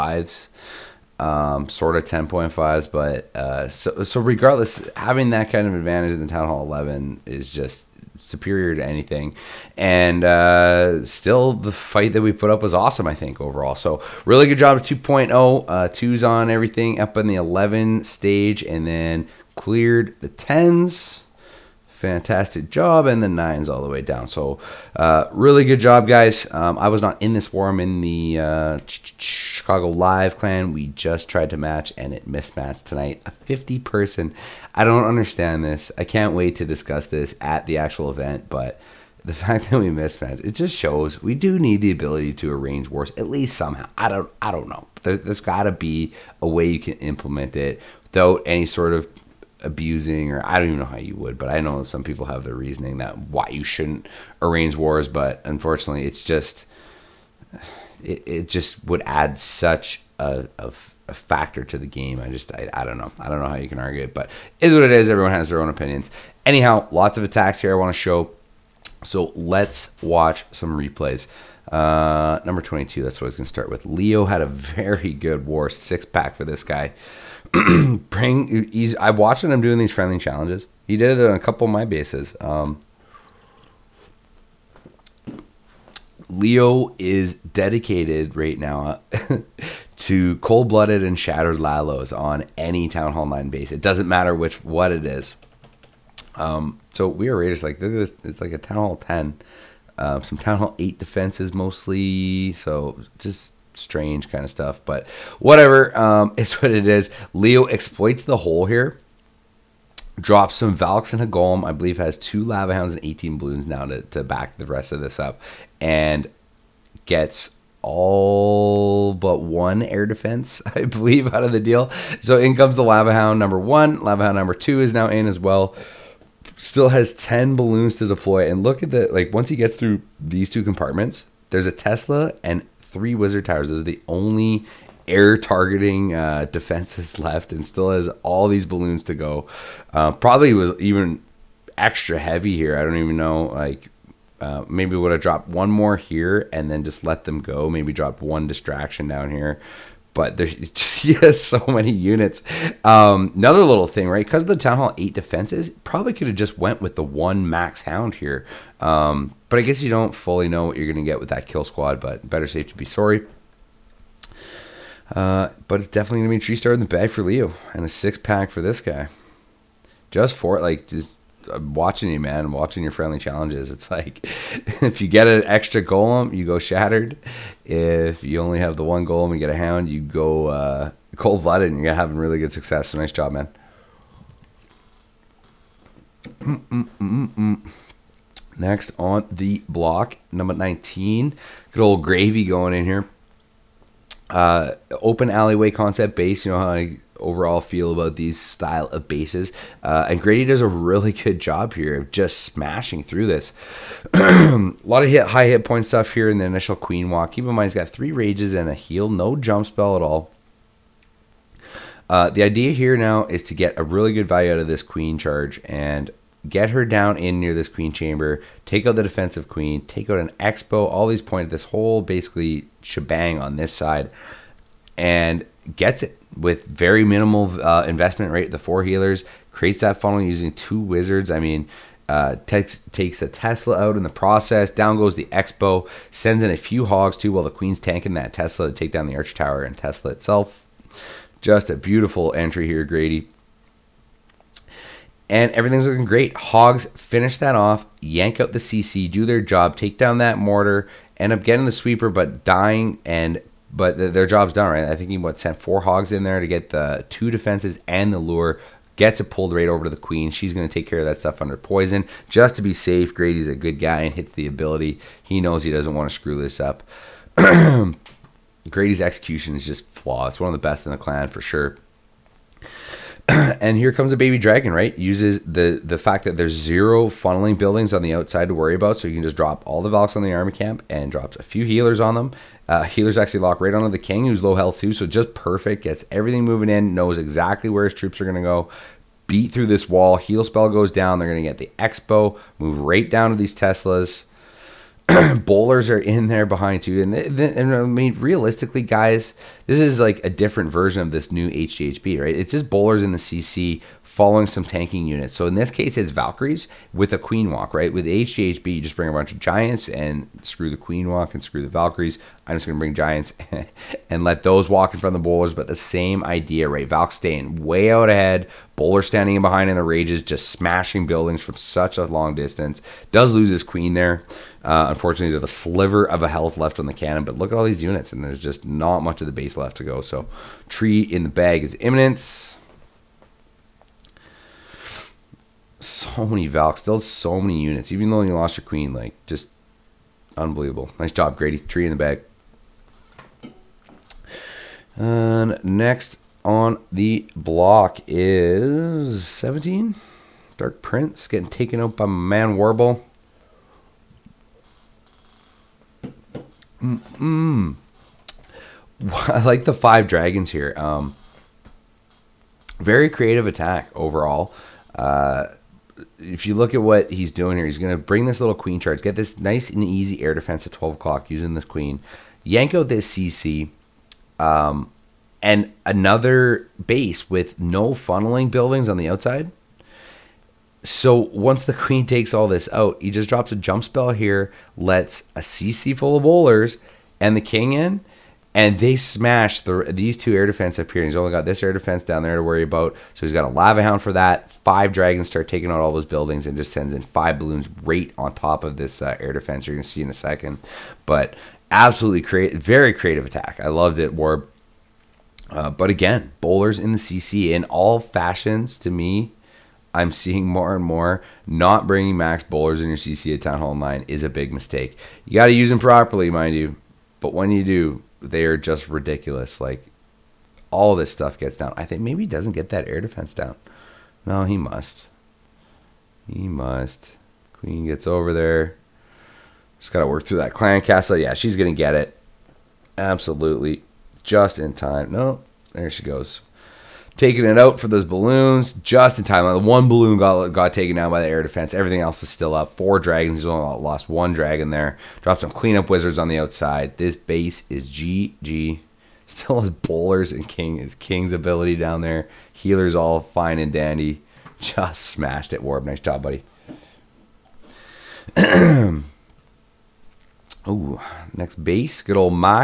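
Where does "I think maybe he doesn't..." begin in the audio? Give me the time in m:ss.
7:01.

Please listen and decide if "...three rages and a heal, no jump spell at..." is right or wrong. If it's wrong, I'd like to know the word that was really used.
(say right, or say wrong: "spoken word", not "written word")
right.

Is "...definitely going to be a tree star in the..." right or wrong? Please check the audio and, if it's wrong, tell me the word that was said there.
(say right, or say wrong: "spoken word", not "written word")
right.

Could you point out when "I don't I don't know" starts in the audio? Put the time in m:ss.
0:43.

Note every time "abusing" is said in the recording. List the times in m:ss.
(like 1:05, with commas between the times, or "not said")
0:49.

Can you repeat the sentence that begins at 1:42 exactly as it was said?
So just strange kind of stuff.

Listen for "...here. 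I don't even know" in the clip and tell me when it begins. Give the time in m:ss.
2:22.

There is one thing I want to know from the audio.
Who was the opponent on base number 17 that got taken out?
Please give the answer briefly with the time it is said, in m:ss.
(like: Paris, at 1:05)
Dark Prince, at 5:50.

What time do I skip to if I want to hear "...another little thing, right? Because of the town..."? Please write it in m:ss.
2:33.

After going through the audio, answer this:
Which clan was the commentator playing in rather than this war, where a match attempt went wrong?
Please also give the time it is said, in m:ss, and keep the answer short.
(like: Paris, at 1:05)
Chicago Live Clan, at 0:29.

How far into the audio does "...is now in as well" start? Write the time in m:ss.
2:04.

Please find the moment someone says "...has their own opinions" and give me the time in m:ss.
1:05.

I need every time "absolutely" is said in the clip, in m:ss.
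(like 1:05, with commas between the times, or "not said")
6:41, 7:12.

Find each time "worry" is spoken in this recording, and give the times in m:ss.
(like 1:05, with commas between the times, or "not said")
4:38, 6:32.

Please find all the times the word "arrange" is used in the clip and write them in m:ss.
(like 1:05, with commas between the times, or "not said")
0:42, 0:54.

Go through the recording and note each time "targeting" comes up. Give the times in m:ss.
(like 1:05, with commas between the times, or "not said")
2:15.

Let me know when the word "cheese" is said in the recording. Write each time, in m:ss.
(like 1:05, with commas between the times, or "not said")
not said.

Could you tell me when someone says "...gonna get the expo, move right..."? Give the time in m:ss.
4:51.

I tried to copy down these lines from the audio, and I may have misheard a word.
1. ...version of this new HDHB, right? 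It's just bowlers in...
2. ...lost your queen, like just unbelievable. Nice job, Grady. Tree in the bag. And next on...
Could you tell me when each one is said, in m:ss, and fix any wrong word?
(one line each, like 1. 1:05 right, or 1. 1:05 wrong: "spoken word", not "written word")
1. 5:00 right
2. 5:38 right.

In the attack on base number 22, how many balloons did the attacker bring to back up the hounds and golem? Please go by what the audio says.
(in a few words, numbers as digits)
18.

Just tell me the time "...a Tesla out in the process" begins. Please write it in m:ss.
3:53.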